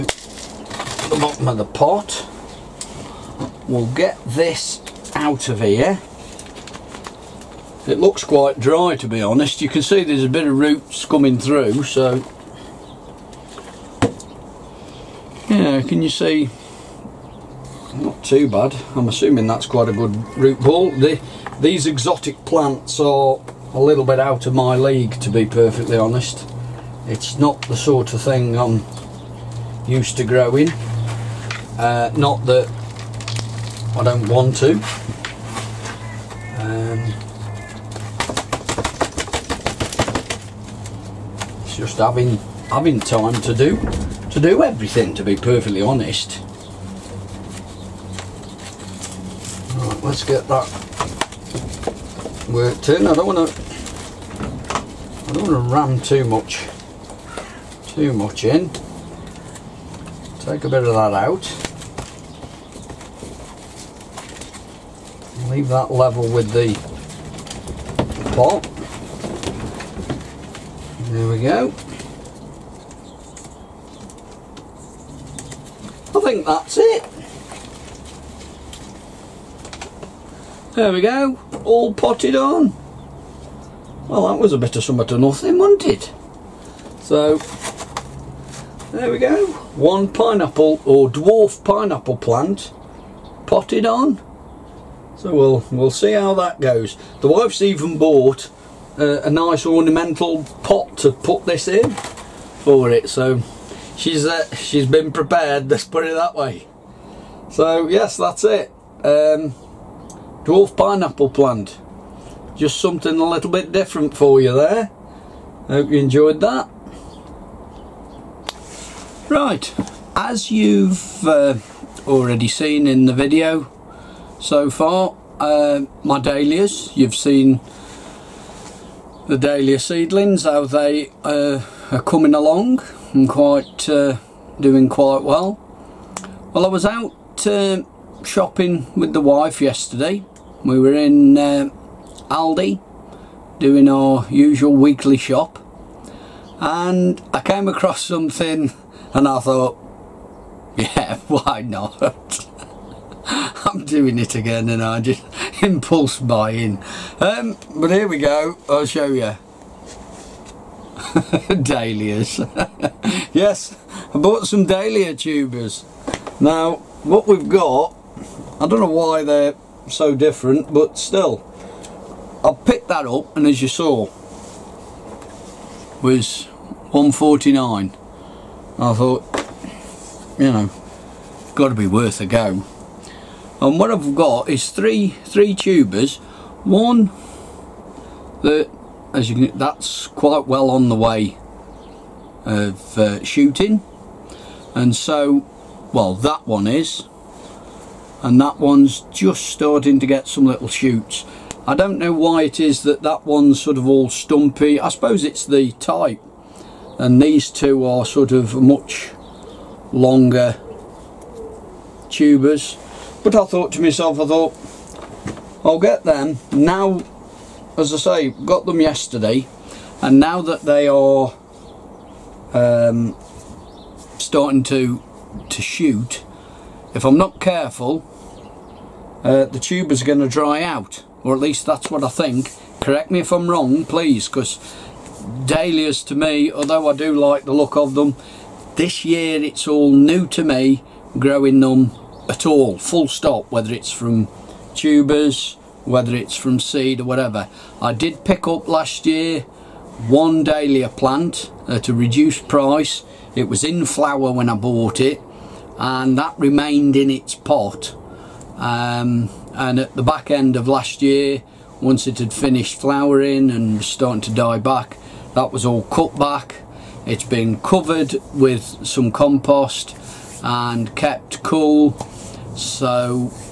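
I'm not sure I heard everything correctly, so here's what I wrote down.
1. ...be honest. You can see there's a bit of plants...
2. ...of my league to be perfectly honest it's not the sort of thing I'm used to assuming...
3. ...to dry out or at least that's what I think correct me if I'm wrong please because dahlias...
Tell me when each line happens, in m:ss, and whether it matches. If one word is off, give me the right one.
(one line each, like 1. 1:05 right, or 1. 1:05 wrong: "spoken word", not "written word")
1. 0:09 wrong: "roots", not "plants"
2. 0:24 wrong: "growing", not "assuming"
3. 3:50 right.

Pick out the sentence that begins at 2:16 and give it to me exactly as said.
Well, I was out uh, shopping with the wife yesterday.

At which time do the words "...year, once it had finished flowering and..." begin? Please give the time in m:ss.
4:21.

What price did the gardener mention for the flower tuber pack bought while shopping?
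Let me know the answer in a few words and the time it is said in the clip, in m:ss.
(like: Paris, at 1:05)
149, at 2:56.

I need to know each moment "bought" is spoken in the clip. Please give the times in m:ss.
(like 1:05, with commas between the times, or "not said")
1:37, 2:44, 4:14.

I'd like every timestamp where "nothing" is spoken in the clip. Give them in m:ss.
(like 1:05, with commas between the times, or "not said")
1:25.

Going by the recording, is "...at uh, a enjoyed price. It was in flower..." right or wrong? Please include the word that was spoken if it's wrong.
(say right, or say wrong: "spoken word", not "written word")
wrong: "reduced", not "enjoyed".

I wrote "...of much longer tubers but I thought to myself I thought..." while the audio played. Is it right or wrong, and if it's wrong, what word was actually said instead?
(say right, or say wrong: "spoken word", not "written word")
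right.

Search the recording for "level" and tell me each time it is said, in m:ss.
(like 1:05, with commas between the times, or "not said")
1:05.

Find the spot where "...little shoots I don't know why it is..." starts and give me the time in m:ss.
3:20.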